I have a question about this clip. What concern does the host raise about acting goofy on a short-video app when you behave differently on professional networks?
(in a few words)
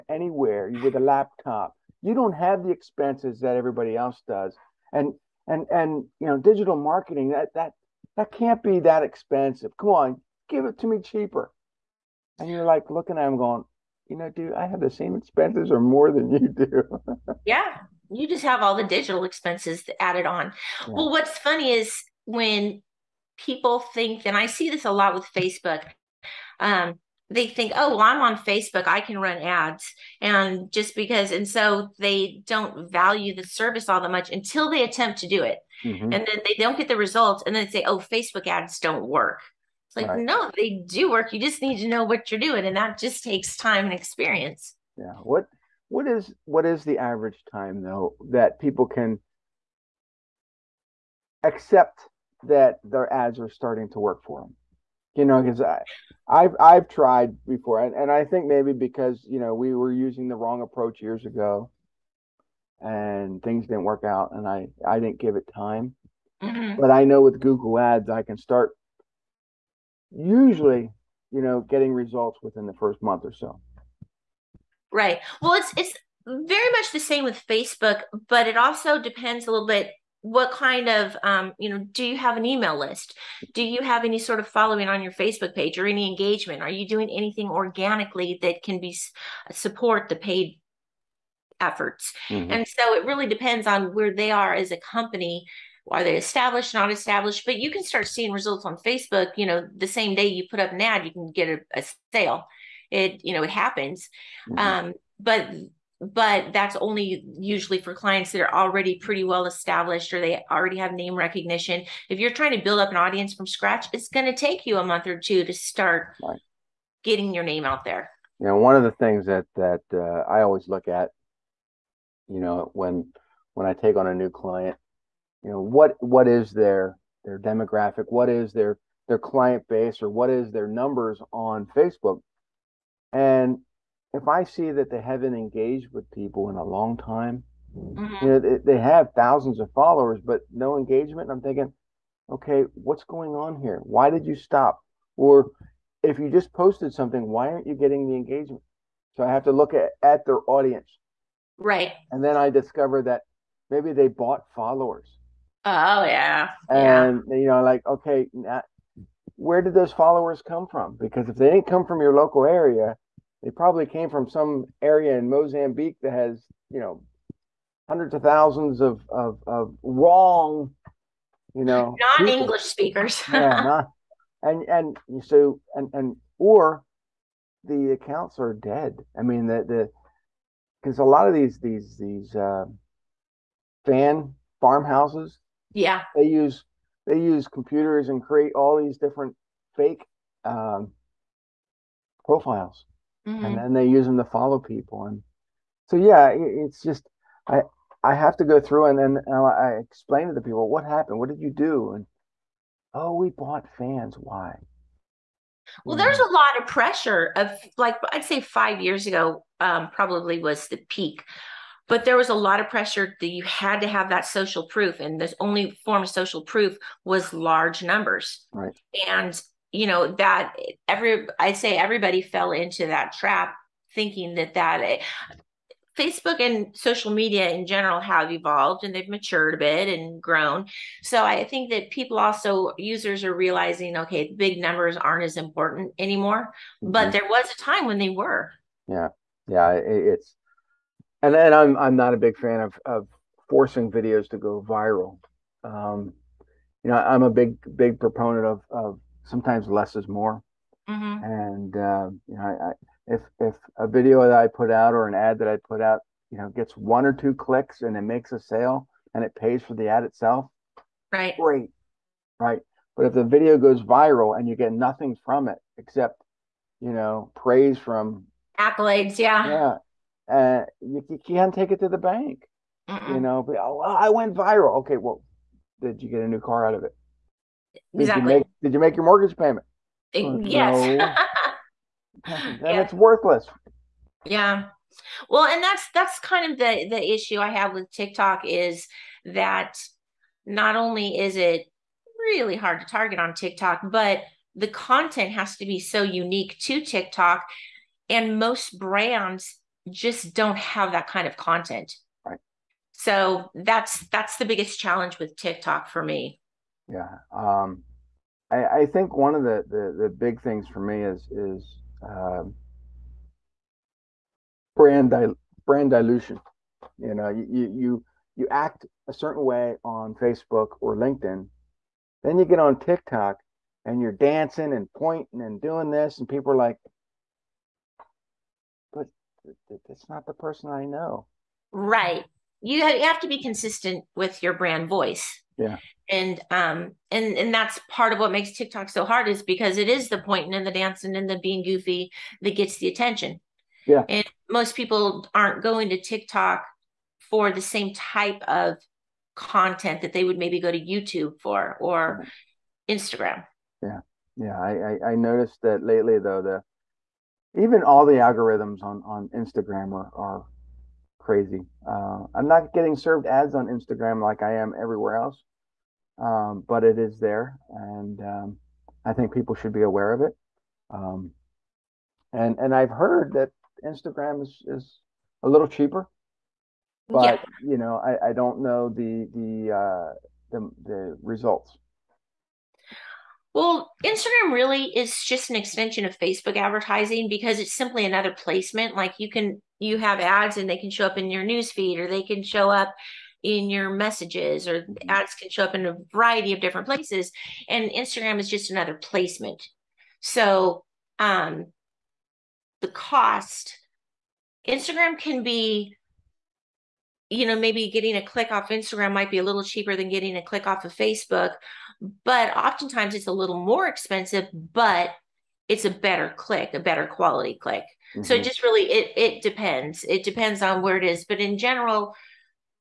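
brand dilution.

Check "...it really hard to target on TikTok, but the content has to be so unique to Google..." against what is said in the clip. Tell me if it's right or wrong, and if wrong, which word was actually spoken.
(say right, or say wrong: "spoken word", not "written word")
wrong: "TikTok", not "Google".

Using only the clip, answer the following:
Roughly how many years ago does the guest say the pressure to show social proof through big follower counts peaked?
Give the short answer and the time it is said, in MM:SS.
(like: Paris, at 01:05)
5 years, at 03:28.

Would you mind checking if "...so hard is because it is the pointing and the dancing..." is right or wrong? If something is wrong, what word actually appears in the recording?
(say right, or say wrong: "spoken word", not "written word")
right.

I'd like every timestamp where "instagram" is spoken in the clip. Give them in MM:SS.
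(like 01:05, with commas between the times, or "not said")
05:52, 05:59, 06:03, 06:13, 06:24, 06:37, 06:44, 06:48.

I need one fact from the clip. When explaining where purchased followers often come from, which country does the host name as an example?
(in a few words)
Mozambique.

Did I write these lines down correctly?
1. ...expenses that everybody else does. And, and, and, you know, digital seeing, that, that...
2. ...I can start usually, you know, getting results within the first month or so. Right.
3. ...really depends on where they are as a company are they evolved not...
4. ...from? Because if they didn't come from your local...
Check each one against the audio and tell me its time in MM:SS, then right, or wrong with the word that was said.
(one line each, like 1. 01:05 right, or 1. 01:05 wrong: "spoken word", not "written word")
1. 00:02 wrong: "marketing", not "seeing"
2. 01:08 right
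3. 01:33 wrong: "established", not "evolved"
4. 02:40 right.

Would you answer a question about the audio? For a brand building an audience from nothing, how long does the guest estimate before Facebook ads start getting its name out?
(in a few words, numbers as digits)
a month or two.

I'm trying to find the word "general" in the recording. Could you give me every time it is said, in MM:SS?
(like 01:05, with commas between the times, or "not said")
03:47, 07:01.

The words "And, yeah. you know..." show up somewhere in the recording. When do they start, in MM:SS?
02:36.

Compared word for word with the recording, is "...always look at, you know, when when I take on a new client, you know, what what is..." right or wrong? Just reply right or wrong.
right.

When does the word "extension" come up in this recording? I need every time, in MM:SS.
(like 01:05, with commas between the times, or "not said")
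06:25.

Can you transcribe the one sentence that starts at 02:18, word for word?
you know, they, they, have thousands of followers, but no engagement.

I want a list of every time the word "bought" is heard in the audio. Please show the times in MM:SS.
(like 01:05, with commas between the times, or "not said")
02:34, 03:23.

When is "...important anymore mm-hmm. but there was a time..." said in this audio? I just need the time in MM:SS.
03:55.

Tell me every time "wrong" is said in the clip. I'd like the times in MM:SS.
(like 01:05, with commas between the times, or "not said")
01:00, 02:49.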